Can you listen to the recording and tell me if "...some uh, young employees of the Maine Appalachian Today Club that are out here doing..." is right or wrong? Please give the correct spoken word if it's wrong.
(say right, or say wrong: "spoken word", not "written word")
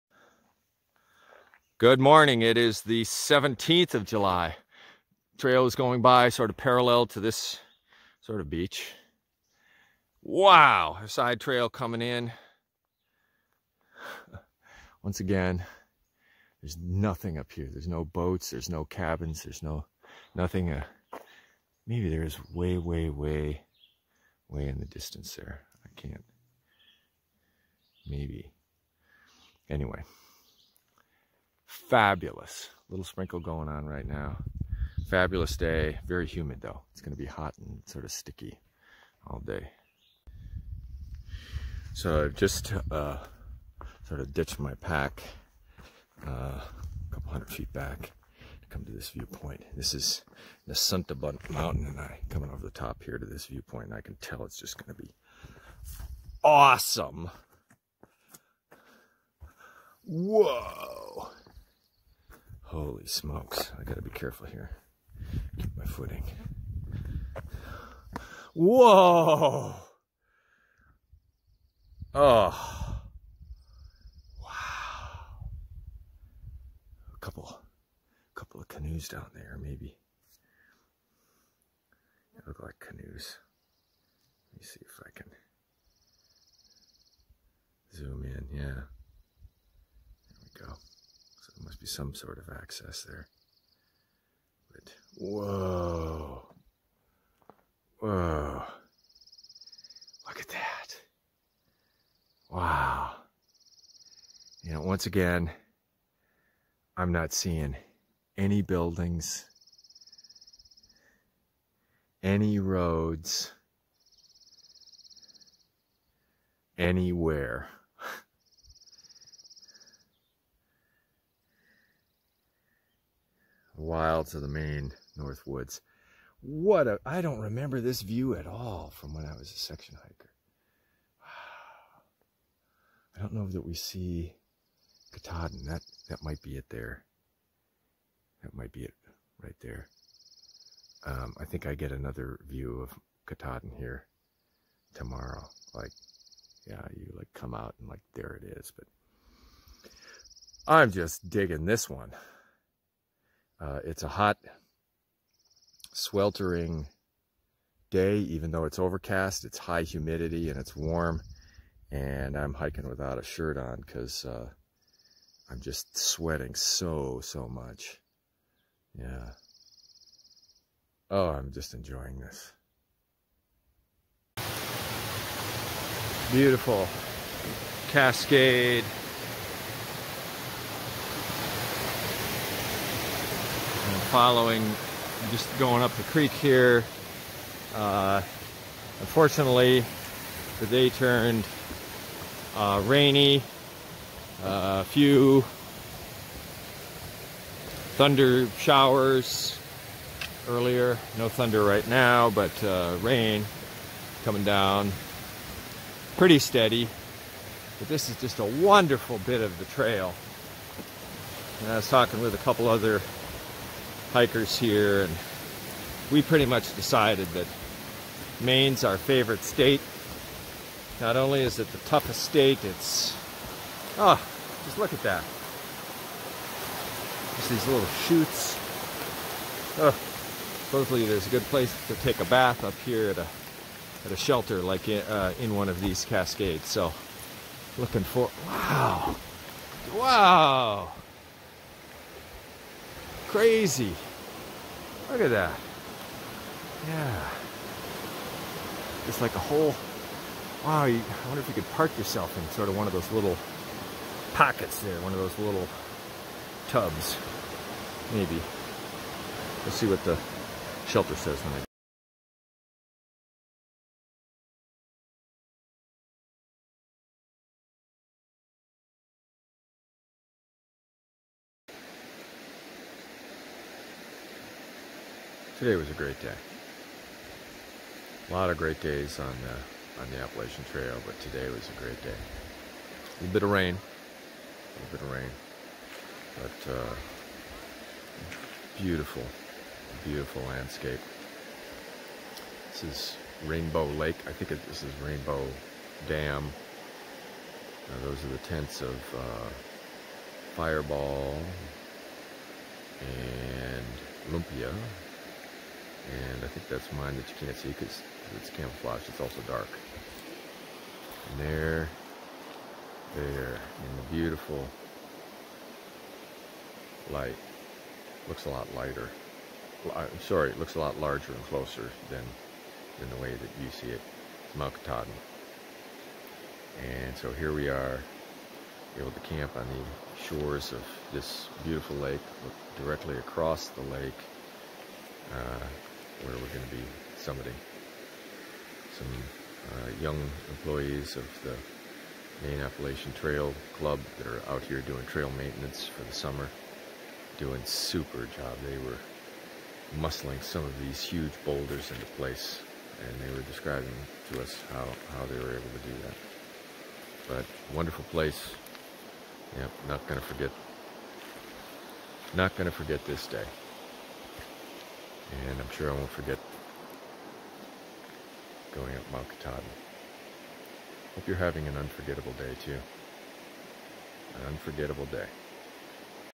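wrong: "Trail", not "Today".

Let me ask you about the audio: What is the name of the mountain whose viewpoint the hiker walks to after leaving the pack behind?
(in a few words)
Santa Mountain.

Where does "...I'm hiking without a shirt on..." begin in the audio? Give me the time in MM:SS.
02:42.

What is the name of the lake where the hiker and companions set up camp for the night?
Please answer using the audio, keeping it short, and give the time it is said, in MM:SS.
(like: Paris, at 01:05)
Rainbow Lake, at 04:53.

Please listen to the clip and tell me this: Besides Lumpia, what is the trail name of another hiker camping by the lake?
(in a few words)
Fireball.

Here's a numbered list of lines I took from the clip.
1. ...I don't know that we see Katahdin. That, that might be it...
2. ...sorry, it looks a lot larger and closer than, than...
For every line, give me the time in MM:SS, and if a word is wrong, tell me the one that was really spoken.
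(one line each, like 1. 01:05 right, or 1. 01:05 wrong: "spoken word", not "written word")
1. 02:13 right
2. 05:20 right.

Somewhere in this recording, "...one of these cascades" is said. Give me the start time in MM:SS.
03:55.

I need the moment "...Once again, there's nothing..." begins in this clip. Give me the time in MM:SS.
00:15.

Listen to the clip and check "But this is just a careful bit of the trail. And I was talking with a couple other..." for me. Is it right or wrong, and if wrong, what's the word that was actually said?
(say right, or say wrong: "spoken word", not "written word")
wrong: "wonderful", not "careful".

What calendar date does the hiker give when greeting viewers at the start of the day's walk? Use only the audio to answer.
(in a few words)
July 17.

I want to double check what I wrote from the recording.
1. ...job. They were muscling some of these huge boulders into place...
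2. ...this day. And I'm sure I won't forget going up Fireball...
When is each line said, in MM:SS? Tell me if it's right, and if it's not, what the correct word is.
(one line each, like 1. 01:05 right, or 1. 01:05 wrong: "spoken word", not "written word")
1. 05:48 right
2. 06:03 wrong: "Mount", not "Fireball".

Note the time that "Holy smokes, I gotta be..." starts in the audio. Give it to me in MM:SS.
01:02.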